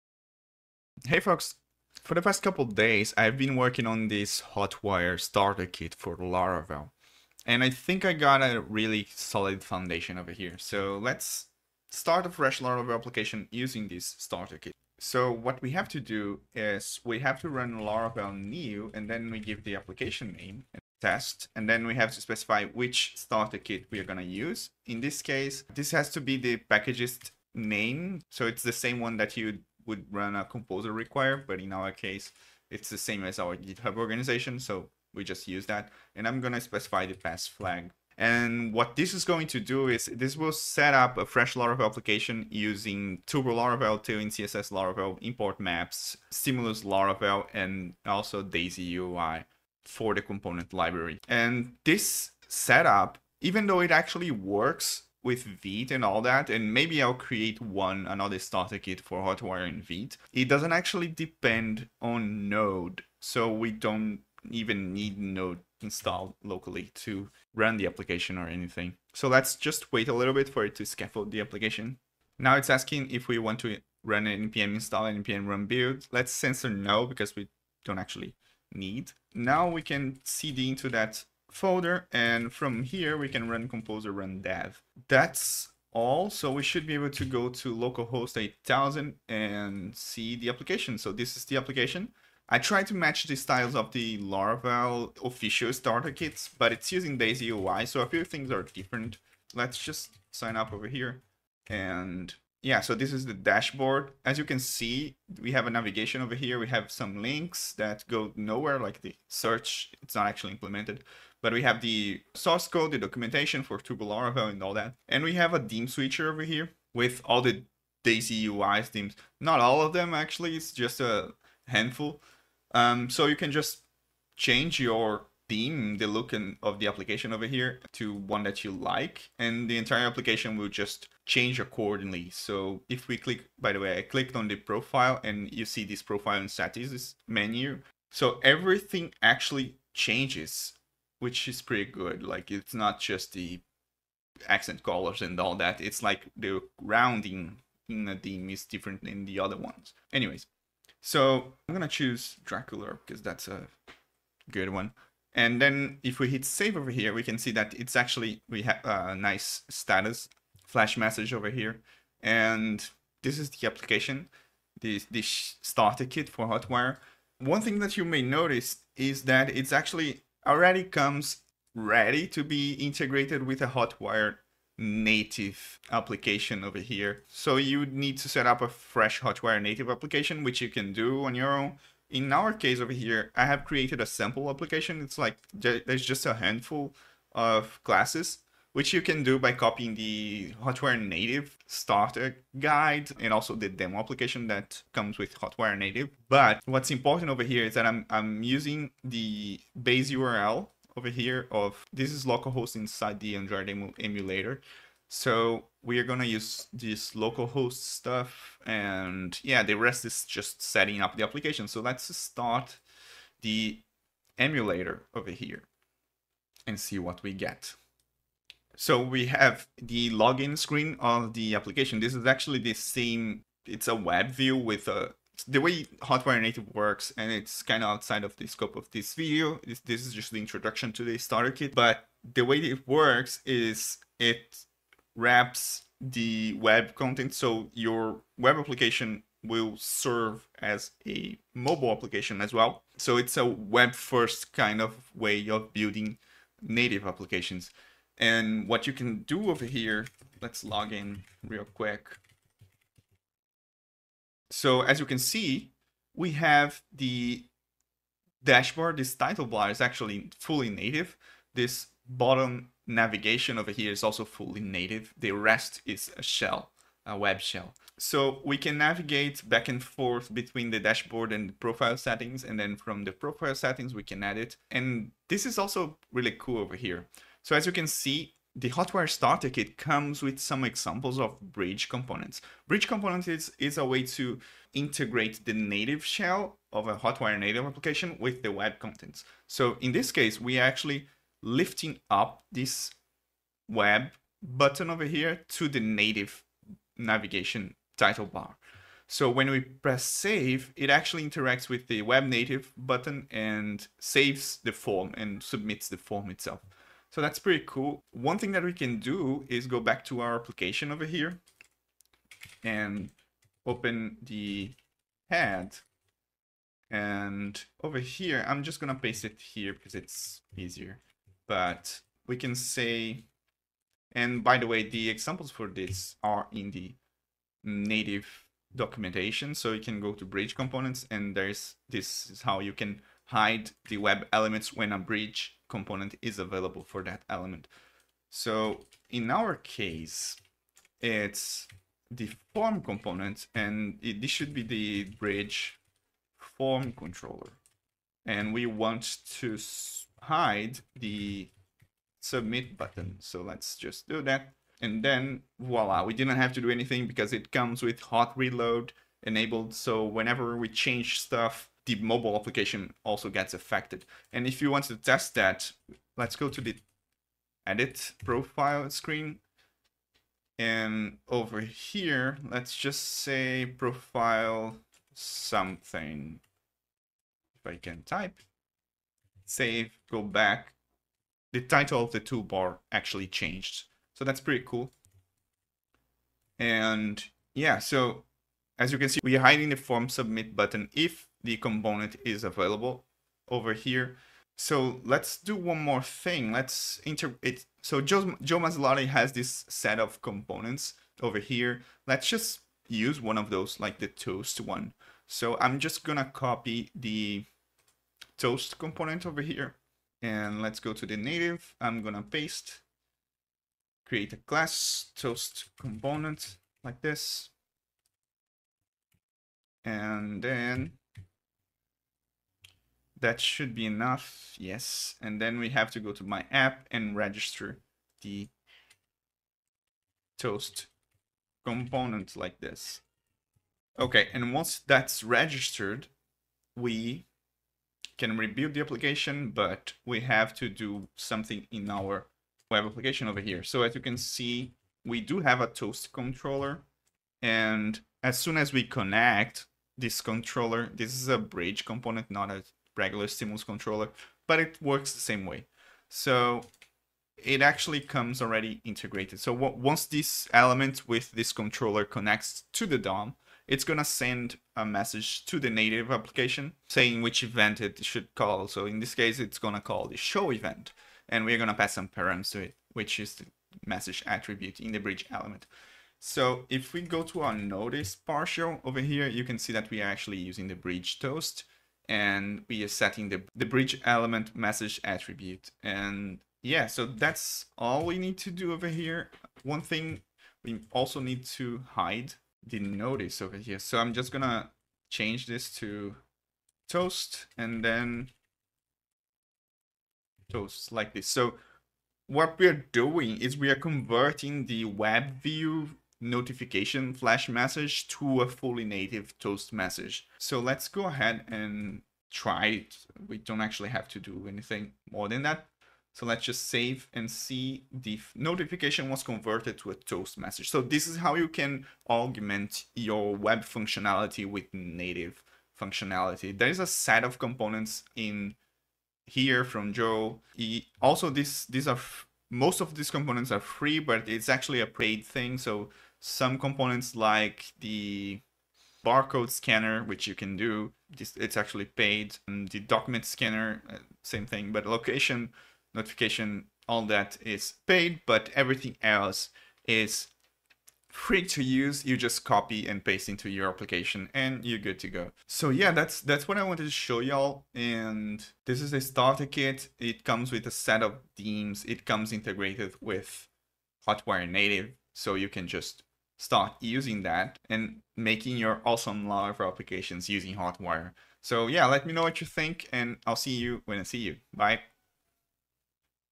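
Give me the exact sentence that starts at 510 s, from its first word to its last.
So let's go ahead and try it.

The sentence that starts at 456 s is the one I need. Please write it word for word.
So it actually comes already integrated.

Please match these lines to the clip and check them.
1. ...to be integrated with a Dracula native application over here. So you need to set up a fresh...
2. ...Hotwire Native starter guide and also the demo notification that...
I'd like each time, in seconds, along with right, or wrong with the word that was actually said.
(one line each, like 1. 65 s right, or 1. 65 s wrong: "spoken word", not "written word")
1. 172 s wrong: "Hotwire", not "Dracula"
2. 190 s wrong: "application", not "notification".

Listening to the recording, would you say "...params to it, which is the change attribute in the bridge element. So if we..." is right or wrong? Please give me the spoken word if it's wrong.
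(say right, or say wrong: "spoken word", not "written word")
wrong: "message", not "change".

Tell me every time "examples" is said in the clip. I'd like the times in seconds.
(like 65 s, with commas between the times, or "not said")
280 s, 325 s.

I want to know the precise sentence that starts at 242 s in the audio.
So it's a web first kind of way of building native applications.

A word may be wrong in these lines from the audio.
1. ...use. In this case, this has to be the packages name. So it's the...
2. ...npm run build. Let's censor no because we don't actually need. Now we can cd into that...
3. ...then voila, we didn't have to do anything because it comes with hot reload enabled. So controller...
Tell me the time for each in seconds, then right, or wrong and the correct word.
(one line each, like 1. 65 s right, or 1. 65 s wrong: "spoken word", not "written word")
1. 24 s right
2. 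75 s right
3. 355 s wrong: "whenever", not "controller".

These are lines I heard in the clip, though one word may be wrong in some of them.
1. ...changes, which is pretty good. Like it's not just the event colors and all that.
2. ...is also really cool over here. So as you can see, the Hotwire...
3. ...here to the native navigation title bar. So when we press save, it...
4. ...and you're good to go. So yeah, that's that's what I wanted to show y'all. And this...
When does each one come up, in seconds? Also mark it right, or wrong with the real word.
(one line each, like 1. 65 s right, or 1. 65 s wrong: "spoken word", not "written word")
1. 139 s wrong: "accent", not "event"
2. 275 s right
3. 295 s right
4. 554 s right.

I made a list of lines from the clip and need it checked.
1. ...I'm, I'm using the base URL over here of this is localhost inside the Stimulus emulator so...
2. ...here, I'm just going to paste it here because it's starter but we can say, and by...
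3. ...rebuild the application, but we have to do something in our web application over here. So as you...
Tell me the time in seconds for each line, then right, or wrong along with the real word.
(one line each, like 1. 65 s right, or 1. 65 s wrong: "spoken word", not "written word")
1. 197 s wrong: "Android", not "Stimulus"
2. 317 s wrong: "easier", not "starter"
3. 438 s right.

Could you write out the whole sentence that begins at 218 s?
So we have the login screen of the application.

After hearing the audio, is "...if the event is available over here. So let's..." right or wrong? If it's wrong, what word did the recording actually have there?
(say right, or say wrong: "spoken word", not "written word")
wrong: "component", not "event".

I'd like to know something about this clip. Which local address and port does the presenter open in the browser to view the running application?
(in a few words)
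localhost 8000.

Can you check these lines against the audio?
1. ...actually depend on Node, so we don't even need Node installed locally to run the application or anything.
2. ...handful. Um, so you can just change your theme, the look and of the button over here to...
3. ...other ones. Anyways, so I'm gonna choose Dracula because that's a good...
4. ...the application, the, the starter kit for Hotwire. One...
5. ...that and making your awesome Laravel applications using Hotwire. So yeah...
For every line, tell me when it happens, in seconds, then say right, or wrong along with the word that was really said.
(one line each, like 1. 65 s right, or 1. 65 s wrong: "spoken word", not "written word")
1. 60 s right
2. 121 s wrong: "application", not "button"
3. 149 s right
4. 163 s right
5. 567 s right.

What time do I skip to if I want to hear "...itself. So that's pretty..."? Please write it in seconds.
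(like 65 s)
306 s.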